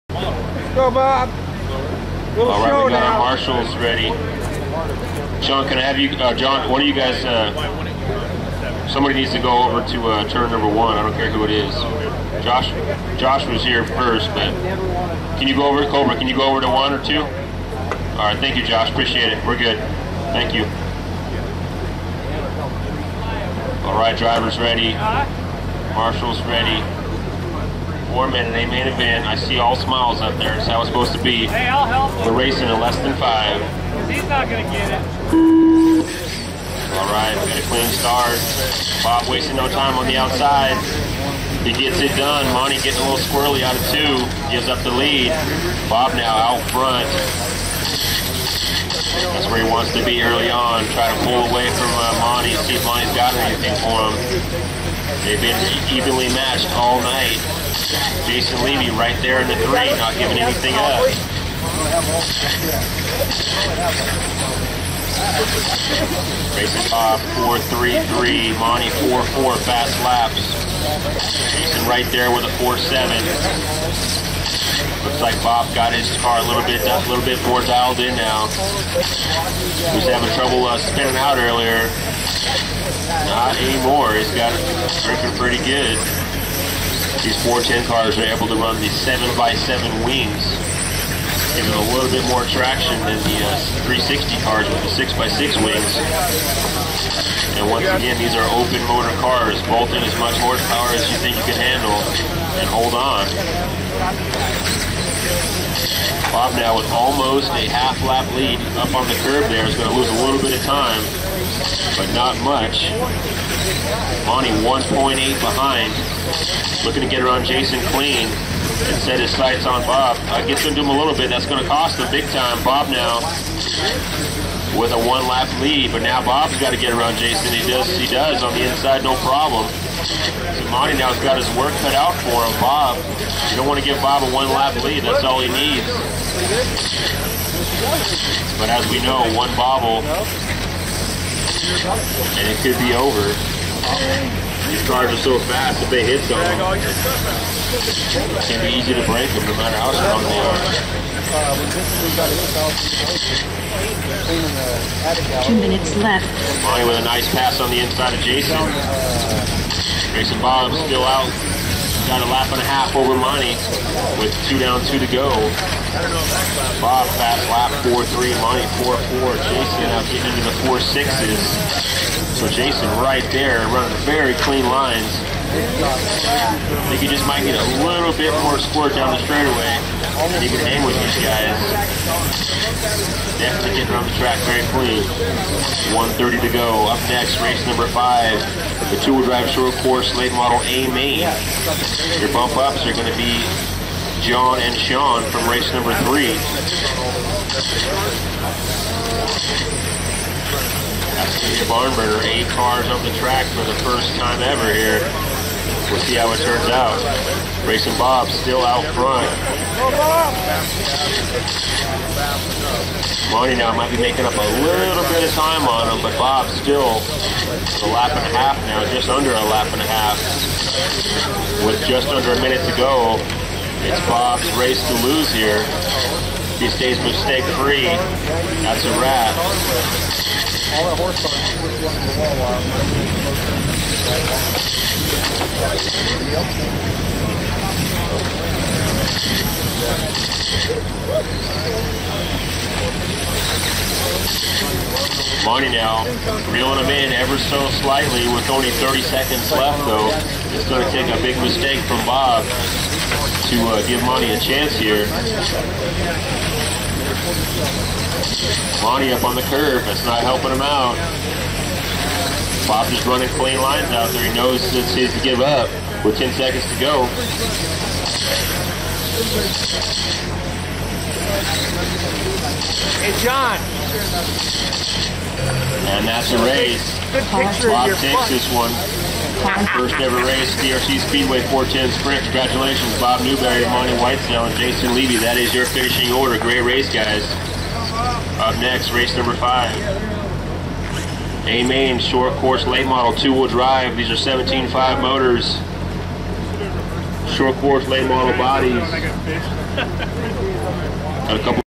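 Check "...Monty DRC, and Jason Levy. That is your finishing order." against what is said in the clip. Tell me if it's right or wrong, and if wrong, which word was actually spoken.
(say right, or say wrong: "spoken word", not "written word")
wrong: "Whitesell", not "DRC".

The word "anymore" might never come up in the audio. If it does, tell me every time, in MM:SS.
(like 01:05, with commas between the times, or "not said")
01:23.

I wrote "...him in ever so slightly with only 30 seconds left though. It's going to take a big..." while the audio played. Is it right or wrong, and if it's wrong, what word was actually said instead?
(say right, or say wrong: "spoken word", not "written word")
right.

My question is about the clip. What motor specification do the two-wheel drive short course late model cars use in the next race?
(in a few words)
17.5.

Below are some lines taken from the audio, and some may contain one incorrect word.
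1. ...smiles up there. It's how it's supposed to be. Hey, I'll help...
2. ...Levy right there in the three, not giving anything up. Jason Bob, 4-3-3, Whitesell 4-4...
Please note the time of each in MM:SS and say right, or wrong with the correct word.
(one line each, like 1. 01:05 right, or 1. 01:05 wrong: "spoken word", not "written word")
1. 00:29 right
2. 00:58 wrong: "Monty", not "Whitesell".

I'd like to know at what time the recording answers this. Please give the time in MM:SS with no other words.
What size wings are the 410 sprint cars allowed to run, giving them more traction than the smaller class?
01:28.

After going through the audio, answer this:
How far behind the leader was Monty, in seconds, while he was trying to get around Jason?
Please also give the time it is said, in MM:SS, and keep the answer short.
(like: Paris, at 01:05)
1.8, at 01:54.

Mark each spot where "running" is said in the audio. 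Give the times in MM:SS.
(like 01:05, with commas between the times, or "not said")
02:53, 04:23.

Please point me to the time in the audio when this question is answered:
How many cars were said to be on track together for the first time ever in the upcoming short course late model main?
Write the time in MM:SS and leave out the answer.
03:22.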